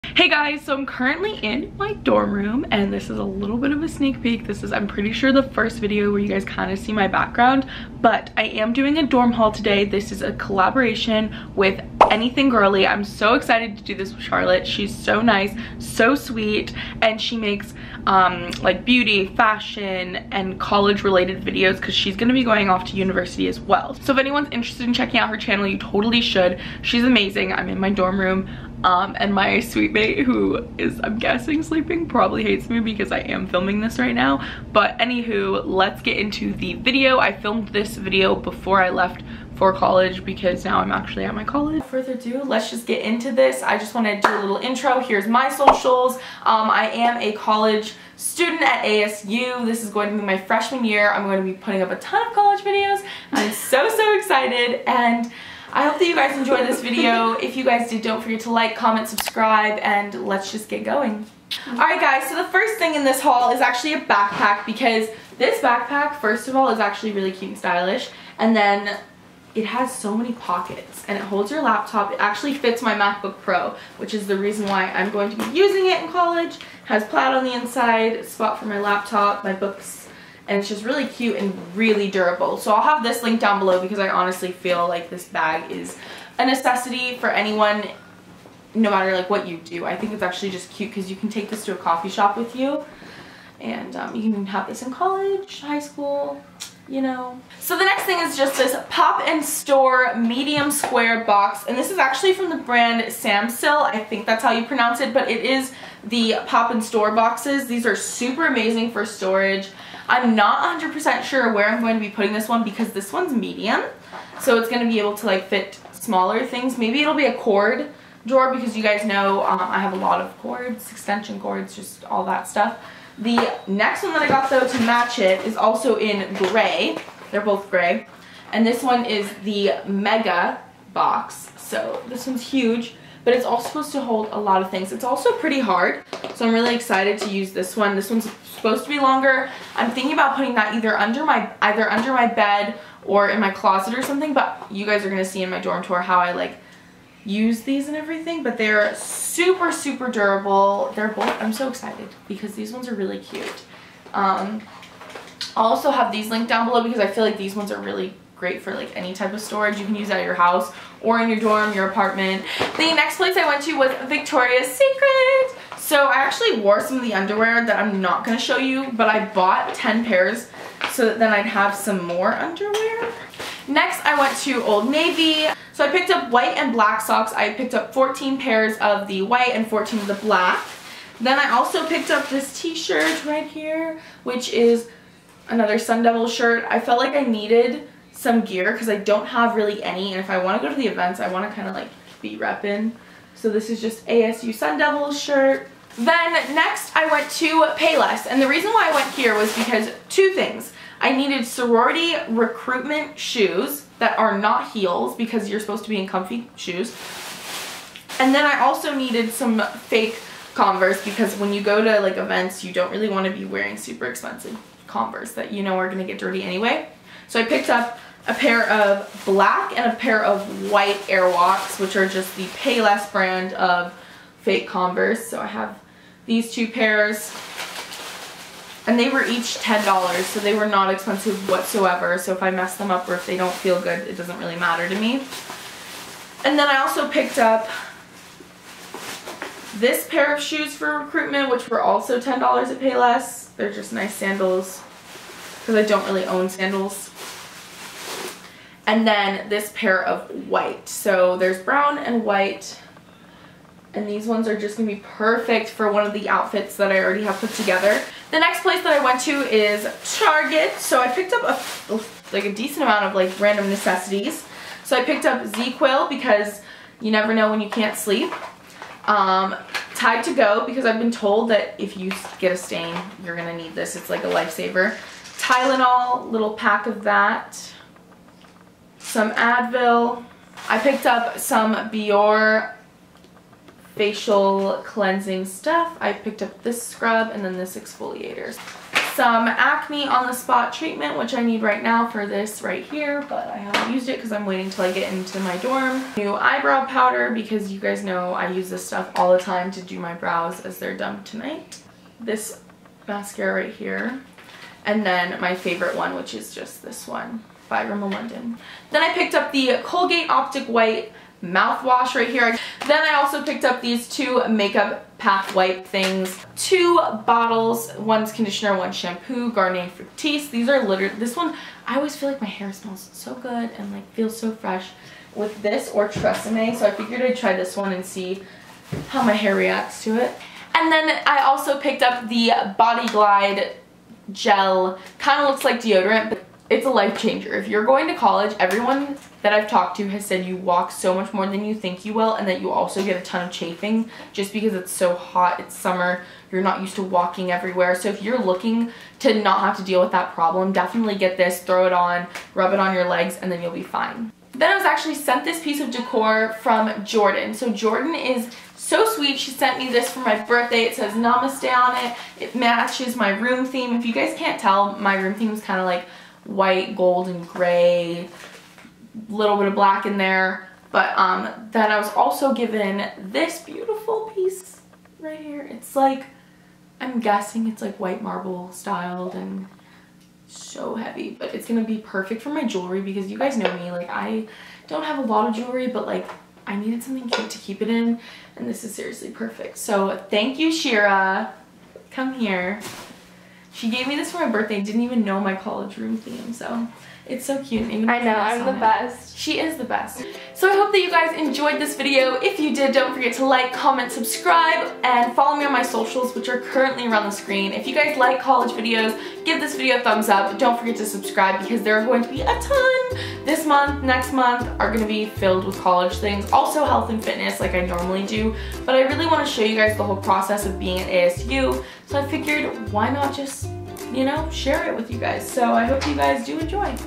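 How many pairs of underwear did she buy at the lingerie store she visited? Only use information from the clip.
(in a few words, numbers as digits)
10.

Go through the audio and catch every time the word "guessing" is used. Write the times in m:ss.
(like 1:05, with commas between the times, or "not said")
0:31, 6:17.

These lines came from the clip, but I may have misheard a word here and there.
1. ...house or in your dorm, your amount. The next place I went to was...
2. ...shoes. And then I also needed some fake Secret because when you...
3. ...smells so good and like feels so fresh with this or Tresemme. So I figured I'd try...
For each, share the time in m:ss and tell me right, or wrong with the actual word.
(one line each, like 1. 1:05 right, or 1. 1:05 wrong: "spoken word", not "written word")
1. 2:40 wrong: "apartment", not "amount"
2. 3:26 wrong: "Converse", not "Secret"
3. 5:22 right.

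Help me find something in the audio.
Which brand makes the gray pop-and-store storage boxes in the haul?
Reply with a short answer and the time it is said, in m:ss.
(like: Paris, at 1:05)
Samsill, at 1:43.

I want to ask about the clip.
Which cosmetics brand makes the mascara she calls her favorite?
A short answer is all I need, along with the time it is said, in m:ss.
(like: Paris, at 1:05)
Rimmel London, at 5:07.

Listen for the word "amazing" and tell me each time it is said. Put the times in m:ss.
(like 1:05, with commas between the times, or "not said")
0:27, 1:48.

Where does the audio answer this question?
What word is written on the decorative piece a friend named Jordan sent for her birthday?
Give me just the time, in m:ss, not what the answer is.
6:01.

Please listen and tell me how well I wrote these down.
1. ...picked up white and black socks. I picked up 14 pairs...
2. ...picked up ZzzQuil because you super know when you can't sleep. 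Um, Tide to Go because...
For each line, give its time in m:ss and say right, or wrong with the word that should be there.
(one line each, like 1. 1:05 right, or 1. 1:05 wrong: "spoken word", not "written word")
1. 2:55 right
2. 4:25 wrong: "never", not "super".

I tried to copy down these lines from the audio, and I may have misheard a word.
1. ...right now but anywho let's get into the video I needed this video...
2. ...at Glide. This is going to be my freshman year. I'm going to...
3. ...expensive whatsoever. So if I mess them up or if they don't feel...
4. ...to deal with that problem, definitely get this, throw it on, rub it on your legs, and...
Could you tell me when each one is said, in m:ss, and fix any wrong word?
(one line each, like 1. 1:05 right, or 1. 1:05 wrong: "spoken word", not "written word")
1. 0:33 wrong: "filmed", not "needed"
2. 0:48 wrong: "ASU", not "Glide"
3. 3:50 right
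4. 5:49 right.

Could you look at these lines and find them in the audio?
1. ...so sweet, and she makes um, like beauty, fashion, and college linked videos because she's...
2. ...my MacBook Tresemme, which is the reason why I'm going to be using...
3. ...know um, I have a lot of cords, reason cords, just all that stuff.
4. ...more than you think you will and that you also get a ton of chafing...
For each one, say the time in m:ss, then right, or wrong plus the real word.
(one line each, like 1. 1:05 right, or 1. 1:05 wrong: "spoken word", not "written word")
1. 0:15 wrong: "related", not "linked"
2. 1:12 wrong: "Pro", not "Tresemme"
3. 1:59 wrong: "extension", not "reason"
4. 5:41 right.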